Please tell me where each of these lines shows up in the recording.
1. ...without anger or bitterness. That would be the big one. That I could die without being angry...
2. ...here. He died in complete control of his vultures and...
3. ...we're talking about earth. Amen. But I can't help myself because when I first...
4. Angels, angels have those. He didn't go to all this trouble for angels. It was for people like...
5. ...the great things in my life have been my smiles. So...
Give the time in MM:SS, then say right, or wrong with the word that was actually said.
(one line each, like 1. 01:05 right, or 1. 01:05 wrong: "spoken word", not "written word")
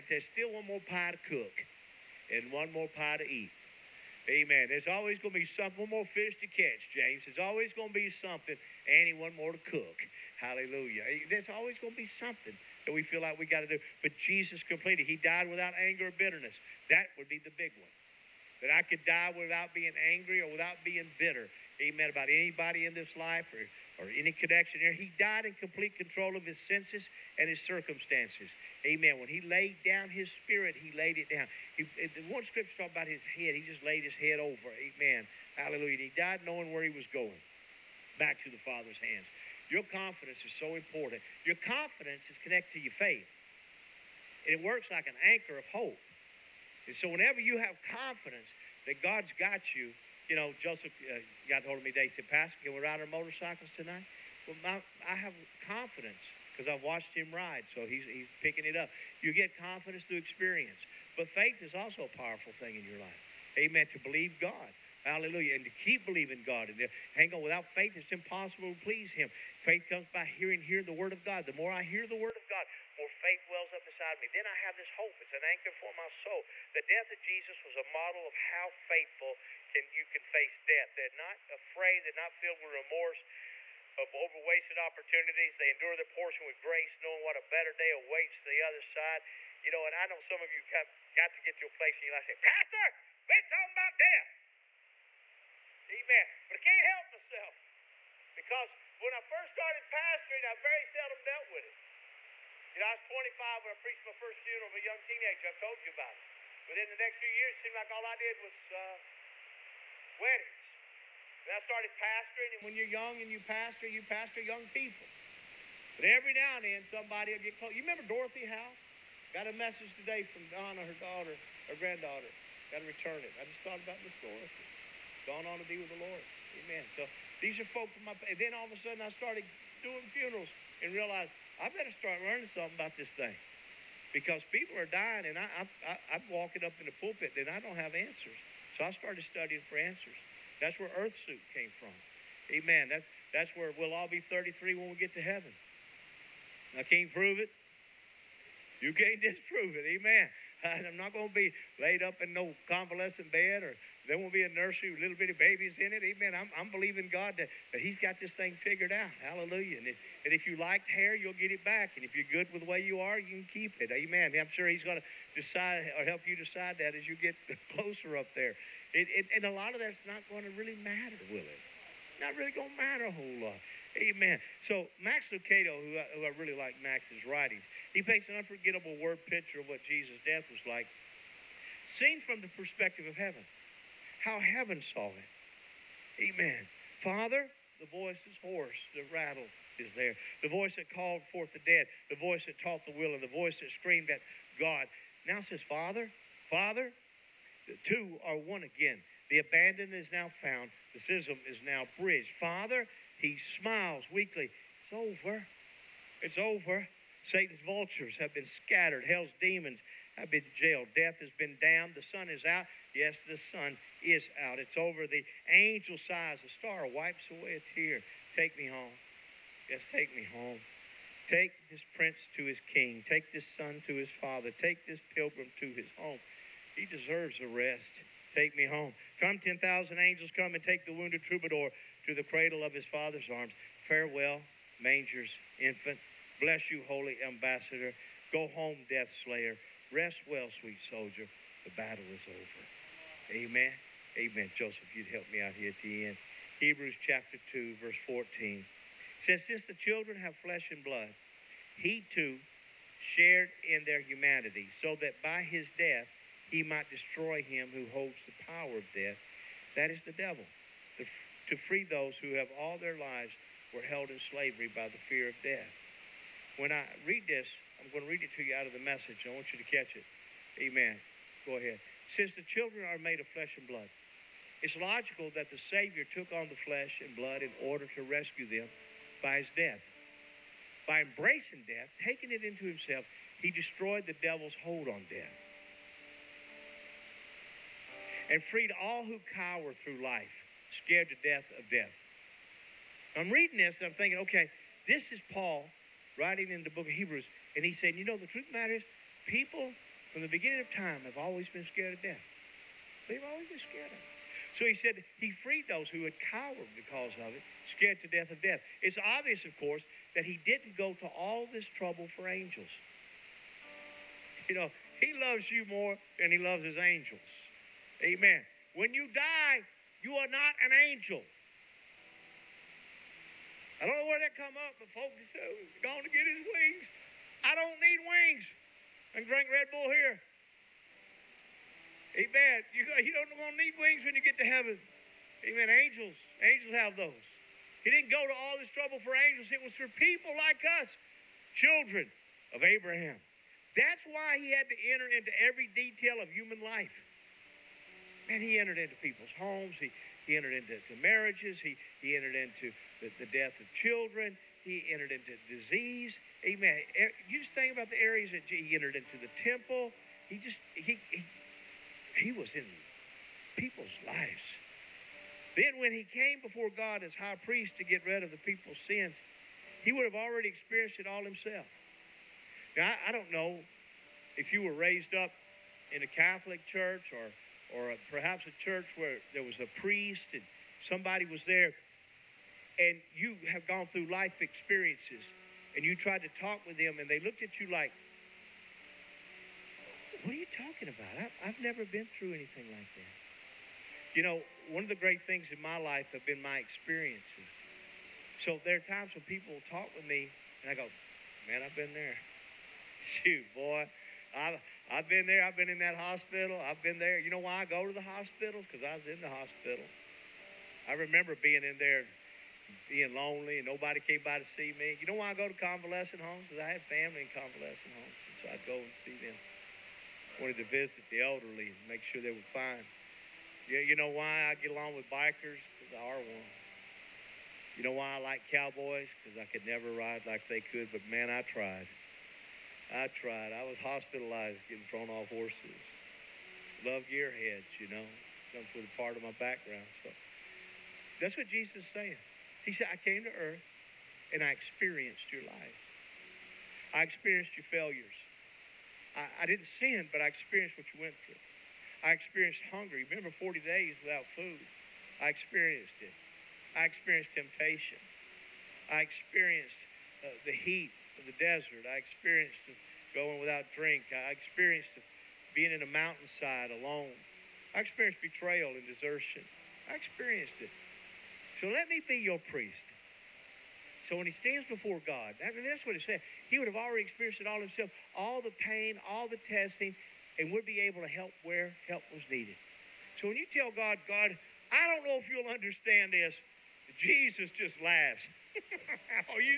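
1. 00:15 right
2. 00:24 wrong: "senses", not "vultures"
3. 01:33 wrong: "death", not "earth"
4. 05:35 right
5. 06:34 wrong: "experiences", not "smiles".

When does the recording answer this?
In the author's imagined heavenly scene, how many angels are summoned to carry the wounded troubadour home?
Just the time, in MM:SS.
03:49.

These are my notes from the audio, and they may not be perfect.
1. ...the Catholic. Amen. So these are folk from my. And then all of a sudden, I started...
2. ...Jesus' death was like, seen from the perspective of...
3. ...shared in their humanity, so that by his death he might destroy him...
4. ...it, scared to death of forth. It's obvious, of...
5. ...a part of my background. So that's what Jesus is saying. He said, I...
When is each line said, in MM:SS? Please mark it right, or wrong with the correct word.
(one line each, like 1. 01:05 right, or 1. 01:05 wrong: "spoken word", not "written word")
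1. 02:05 wrong: "Lord", not "Catholic"
2. 02:59 right
3. 04:13 right
4. 05:07 wrong: "death", not "forth"
5. 07:18 right.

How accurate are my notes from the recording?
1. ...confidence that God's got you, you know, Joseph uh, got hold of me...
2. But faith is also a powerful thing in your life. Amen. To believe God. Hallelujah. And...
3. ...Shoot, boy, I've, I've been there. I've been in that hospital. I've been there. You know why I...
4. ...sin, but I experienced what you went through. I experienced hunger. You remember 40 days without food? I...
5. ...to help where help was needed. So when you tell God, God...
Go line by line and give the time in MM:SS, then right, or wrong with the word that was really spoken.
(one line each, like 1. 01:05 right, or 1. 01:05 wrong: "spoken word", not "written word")
1. 00:47 right
2. 01:01 right
3. 06:43 right
4. 07:29 right
5. 08:01 right.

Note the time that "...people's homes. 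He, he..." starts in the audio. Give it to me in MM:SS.
05:49.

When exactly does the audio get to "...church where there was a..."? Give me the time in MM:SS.
06:18.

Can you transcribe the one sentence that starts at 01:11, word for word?
The more I hear the Word of God, more faith wells up inside me.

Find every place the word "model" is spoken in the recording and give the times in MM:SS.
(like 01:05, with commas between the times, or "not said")
01:17.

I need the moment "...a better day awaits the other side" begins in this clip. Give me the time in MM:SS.
01:27.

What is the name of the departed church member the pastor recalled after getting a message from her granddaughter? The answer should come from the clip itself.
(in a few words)
Dorothy Howe.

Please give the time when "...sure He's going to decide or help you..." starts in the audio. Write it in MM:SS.
02:44.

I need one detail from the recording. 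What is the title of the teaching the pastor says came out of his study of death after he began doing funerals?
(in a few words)
Earth Suit.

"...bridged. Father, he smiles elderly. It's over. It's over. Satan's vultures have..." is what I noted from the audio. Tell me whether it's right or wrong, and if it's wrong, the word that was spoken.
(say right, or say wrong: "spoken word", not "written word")
wrong: "weakly", not "elderly".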